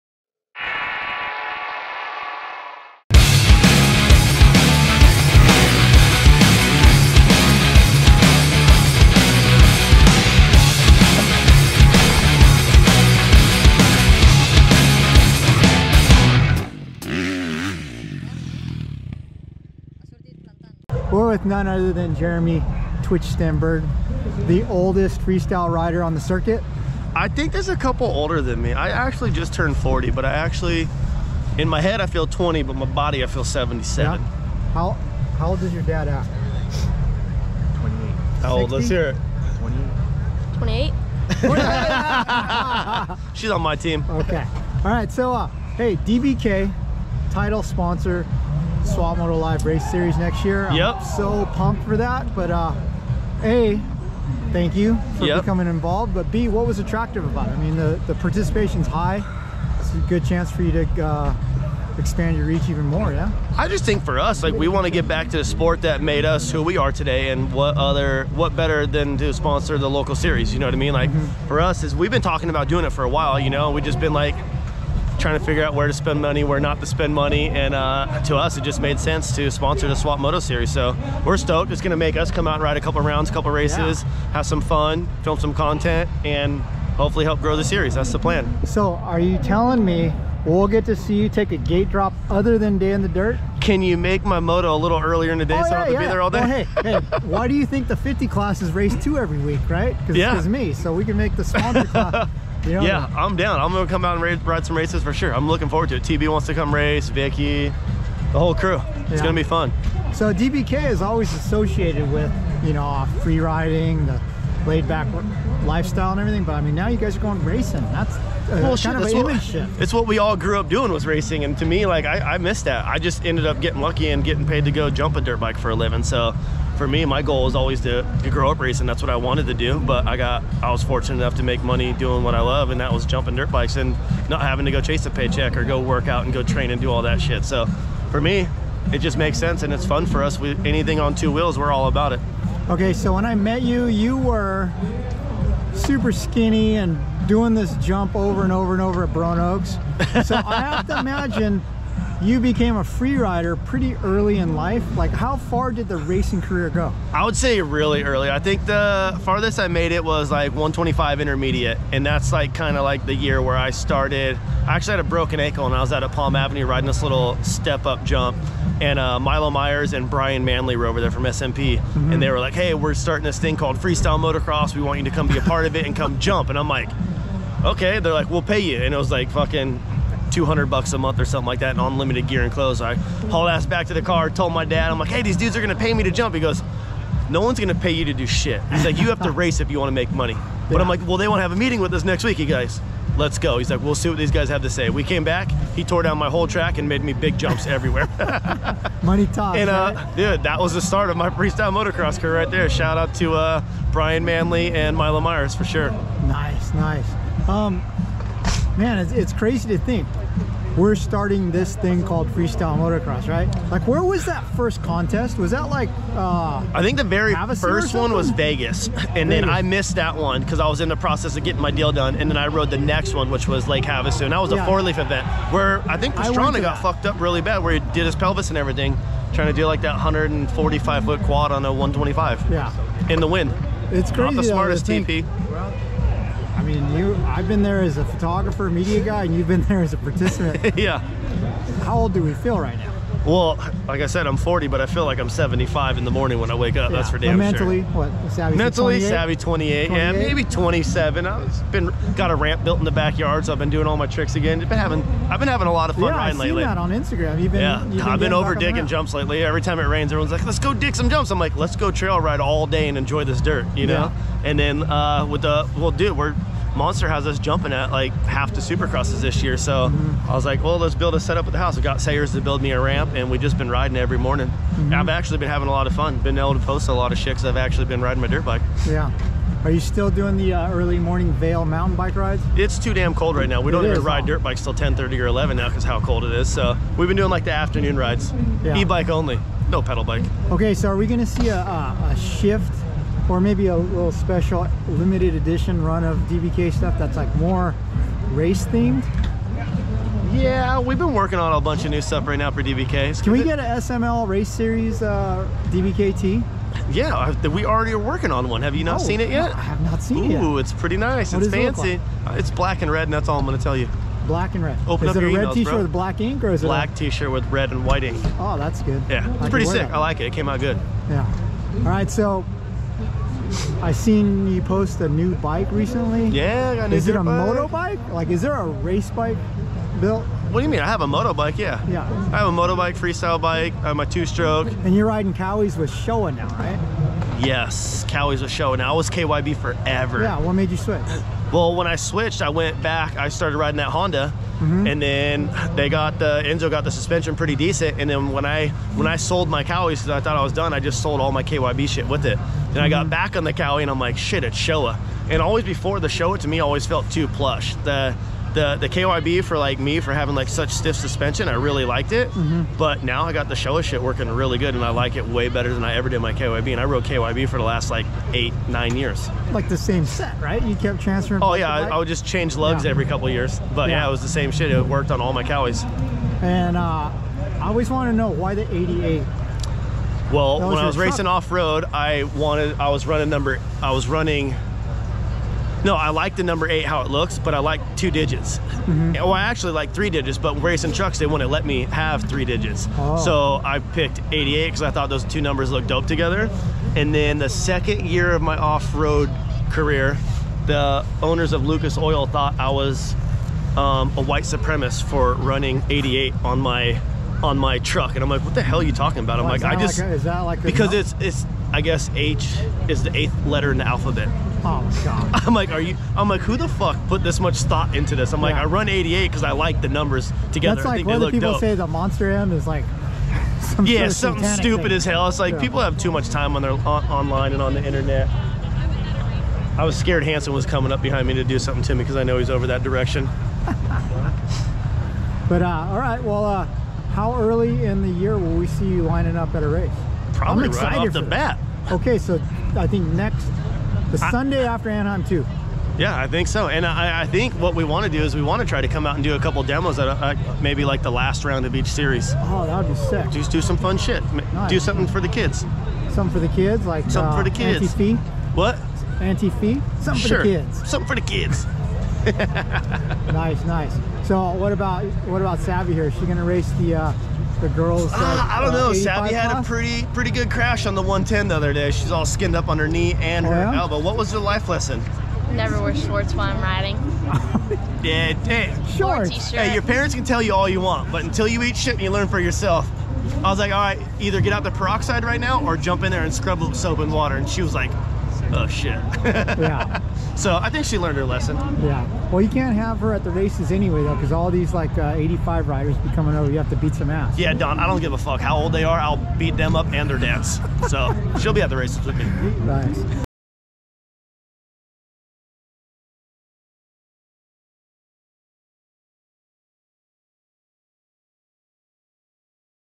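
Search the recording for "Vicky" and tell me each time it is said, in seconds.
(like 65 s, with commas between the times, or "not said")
107 s.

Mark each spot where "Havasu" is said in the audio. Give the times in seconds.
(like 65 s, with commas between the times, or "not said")
217 s, 223 s.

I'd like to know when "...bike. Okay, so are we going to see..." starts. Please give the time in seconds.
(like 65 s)
290 s.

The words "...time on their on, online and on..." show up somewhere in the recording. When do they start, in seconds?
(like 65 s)
426 s.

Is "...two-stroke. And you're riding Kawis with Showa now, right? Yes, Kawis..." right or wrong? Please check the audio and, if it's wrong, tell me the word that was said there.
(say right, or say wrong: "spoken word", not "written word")
right.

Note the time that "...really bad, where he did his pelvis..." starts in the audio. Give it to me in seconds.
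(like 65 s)
227 s.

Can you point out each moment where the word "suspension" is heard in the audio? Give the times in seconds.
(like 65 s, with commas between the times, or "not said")
346 s, 360 s.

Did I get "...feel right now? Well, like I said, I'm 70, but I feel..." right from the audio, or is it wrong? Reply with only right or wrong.
wrong.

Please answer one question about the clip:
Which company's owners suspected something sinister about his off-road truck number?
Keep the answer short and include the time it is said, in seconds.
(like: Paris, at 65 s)
Lucas Oil, at 401 s.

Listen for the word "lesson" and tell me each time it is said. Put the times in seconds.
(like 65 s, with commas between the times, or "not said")
474 s, 491 s.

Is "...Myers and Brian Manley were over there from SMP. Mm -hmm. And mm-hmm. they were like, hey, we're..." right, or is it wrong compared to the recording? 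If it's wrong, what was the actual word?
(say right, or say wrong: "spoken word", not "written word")
right.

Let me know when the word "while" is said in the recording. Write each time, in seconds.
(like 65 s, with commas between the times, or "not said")
73 s, 476 s.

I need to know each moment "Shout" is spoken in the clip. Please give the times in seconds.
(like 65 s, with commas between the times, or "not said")
202 s.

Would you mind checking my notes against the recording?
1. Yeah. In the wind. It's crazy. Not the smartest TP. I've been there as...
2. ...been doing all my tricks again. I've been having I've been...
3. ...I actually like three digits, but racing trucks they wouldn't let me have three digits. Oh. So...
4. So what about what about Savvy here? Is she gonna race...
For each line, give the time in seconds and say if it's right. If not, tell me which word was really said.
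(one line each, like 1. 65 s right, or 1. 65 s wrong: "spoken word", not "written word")
1. 232 s right
2. 253 s right
3. 389 s right
4. 464 s right.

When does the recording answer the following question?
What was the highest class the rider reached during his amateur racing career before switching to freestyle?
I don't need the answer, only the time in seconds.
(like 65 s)
160 s.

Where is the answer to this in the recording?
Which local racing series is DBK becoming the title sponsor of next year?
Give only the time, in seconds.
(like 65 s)
48 s.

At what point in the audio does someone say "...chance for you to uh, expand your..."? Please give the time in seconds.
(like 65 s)
60 s.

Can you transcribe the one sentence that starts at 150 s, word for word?
So I have to imagine you became a free rider pretty early in life.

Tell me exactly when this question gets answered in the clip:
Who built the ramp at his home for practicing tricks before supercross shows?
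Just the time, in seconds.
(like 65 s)
272 s.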